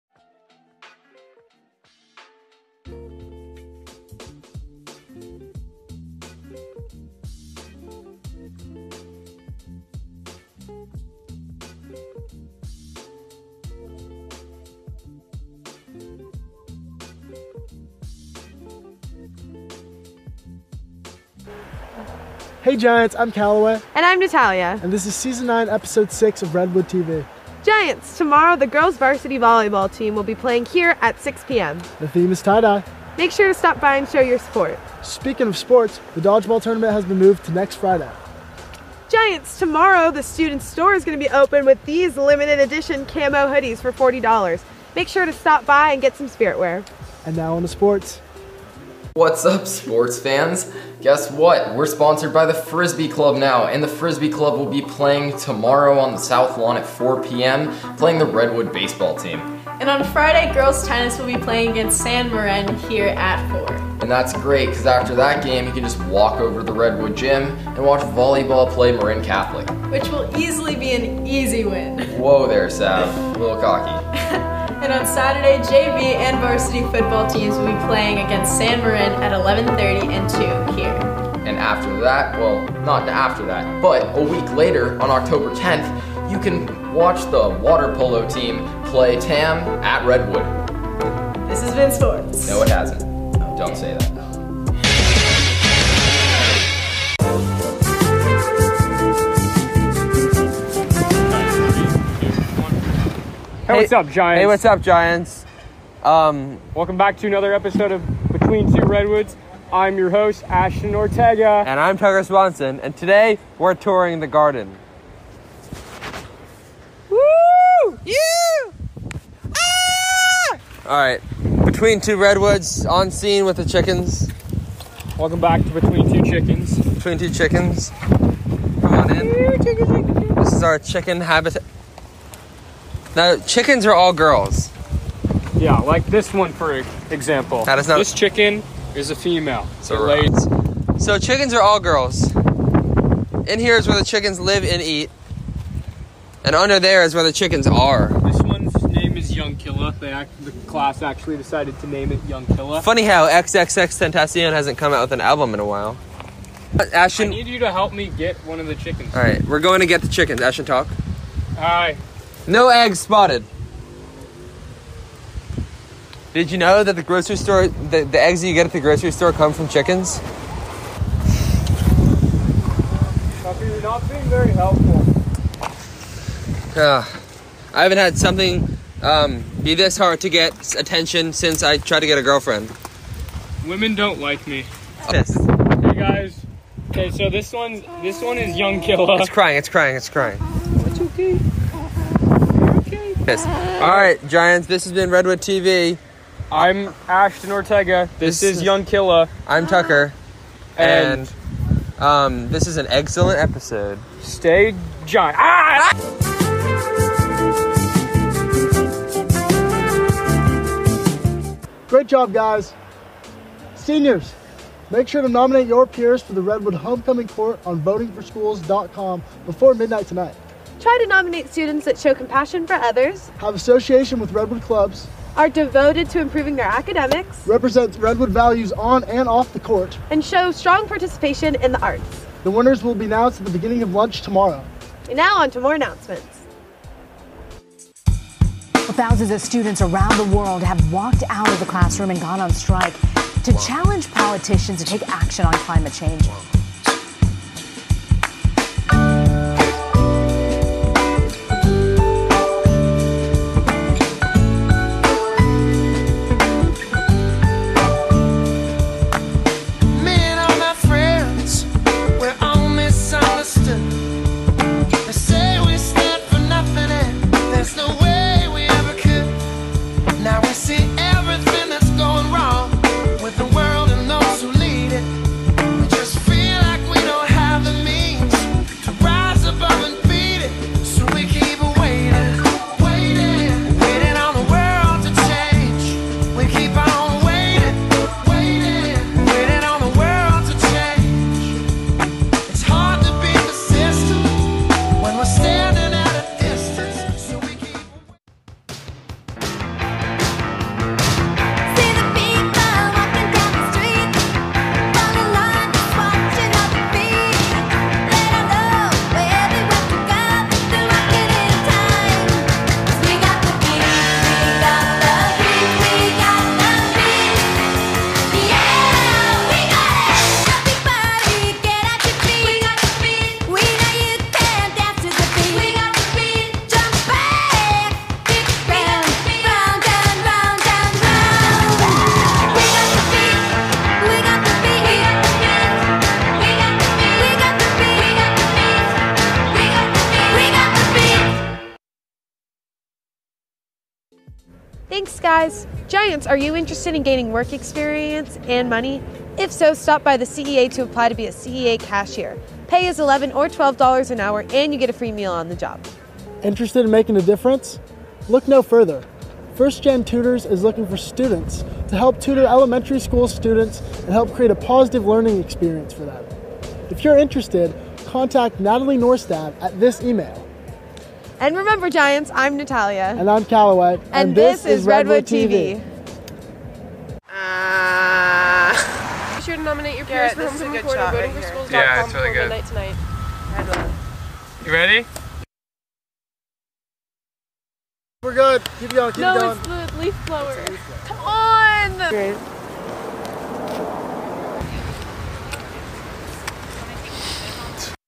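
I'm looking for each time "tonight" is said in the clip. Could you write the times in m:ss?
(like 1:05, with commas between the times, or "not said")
3:40, 6:22.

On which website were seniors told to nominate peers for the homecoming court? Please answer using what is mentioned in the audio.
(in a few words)
votingforschools.com.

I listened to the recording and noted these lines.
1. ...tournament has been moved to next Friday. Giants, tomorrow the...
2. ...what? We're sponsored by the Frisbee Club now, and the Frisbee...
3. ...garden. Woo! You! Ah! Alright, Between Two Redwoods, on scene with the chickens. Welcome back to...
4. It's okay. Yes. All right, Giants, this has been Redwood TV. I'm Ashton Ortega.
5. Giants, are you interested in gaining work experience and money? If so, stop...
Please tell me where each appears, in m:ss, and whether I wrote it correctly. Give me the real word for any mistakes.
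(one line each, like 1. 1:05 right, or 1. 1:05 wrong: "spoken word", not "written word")
1. 0:36 right
2. 0:51 right
3. 1:54 right
4. 3:10 right
5. 5:45 right.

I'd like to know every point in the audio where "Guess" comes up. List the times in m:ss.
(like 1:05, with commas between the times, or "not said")
0:51.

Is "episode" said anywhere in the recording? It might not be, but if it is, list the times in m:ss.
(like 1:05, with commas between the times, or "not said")
0:25, 1:47, 3:23.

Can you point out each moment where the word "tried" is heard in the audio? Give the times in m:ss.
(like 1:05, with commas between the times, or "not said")
3:01.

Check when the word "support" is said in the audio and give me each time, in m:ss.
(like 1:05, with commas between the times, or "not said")
0:34.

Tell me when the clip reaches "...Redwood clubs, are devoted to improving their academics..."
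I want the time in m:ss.
3:44.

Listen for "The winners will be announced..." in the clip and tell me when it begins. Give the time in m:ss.
3:52.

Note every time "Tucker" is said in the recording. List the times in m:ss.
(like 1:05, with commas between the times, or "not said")
1:51, 2:53, 3:19.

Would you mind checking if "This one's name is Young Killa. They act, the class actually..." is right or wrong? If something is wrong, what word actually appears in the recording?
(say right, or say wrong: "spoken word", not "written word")
right.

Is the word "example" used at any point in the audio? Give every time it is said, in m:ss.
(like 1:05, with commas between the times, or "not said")
2:17.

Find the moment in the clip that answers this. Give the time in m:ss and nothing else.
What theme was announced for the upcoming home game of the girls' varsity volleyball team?
0:32.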